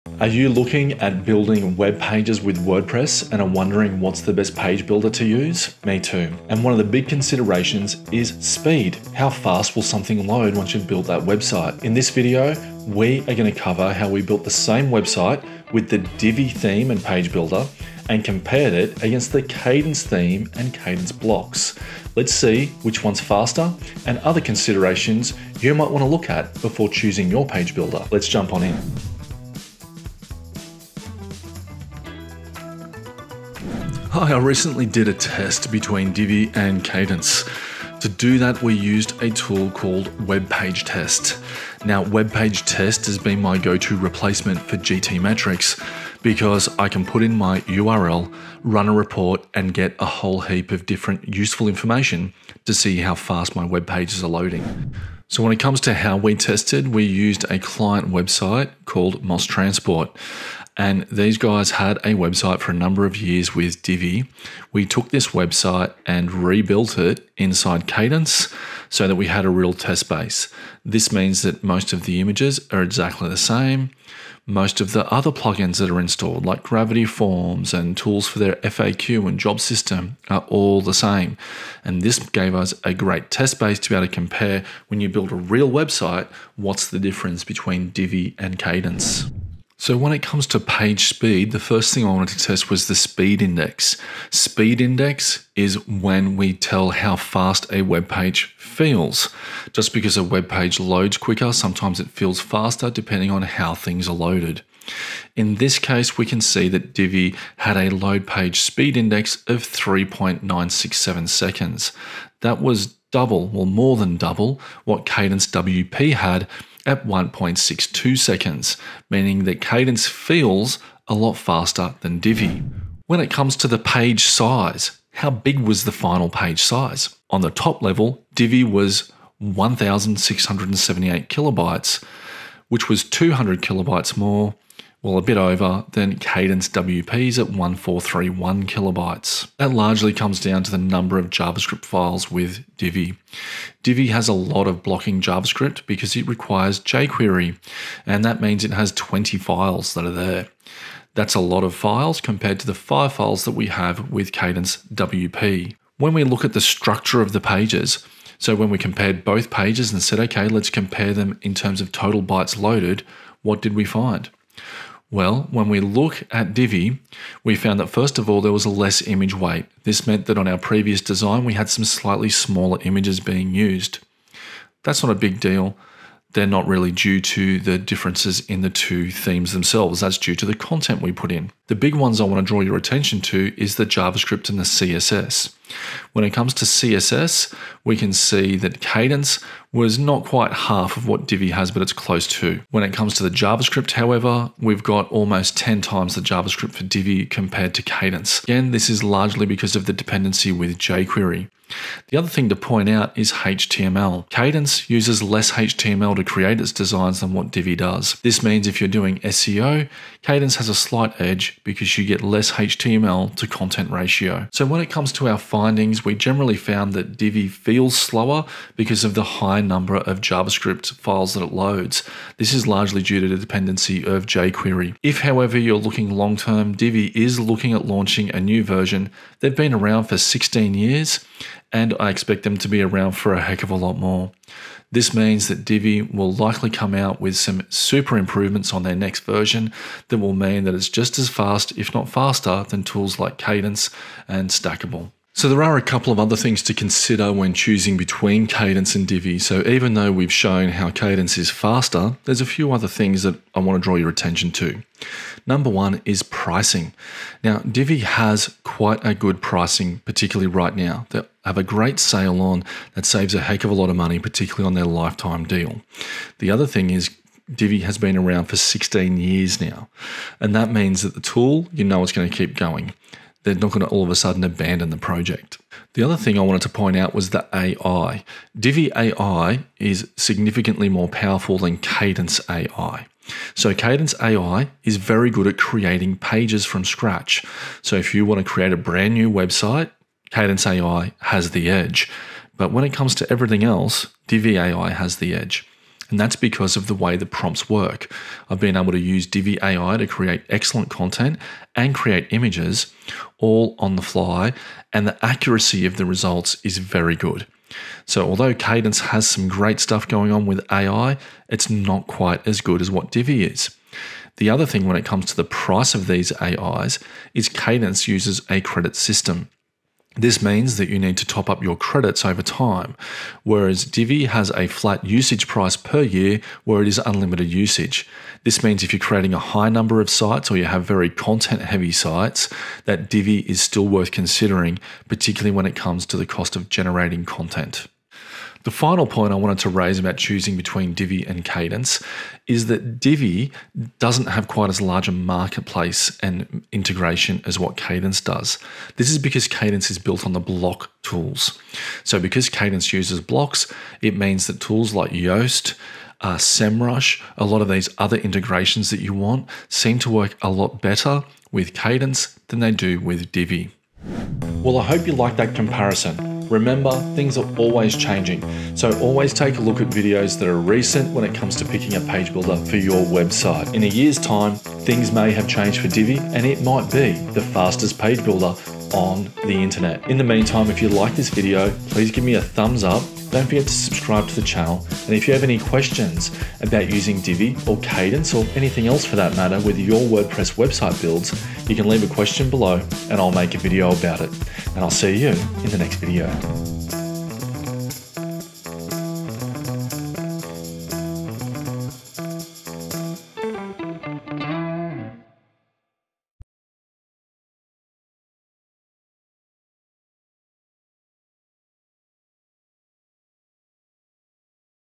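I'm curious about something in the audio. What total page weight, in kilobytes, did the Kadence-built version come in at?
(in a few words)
1431 kilobytes.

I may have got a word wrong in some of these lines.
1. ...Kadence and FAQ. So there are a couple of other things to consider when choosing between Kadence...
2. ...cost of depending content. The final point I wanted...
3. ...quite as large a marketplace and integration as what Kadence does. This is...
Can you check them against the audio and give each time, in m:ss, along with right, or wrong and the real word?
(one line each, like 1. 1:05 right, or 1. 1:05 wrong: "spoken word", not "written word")
1. 4:03 wrong: "Stackable", not "FAQ"
2. 5:36 wrong: "generating", not "depending"
3. 5:44 right.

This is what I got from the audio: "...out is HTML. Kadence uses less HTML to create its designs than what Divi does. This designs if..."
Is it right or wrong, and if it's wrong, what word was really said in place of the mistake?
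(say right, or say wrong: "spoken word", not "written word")
wrong: "means", not "designs".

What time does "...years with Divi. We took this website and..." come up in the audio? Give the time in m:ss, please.
1:03.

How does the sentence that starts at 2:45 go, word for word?
Well, when we look at Divi, we found that first of all, there was a less image weight.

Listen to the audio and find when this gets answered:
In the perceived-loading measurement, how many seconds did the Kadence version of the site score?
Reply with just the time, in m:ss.
1:57.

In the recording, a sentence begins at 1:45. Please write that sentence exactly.
In this case, we can see that Divi had a load page speed index of 3.967 seconds.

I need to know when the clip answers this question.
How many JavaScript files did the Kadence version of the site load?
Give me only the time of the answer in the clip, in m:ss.
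2:32.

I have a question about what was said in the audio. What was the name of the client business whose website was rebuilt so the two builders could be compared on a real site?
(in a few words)
Moss Transport.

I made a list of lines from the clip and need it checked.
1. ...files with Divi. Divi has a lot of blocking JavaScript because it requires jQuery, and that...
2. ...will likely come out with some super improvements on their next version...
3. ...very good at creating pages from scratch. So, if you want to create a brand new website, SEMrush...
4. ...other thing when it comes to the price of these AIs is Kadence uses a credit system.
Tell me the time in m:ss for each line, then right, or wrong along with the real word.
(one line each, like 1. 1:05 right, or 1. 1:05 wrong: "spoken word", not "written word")
1. 2:21 right
2. 3:56 right
3. 4:44 wrong: "Kadence", not "SEMrush"
4. 5:14 right.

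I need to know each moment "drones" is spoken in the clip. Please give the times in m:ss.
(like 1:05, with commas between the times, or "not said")
not said.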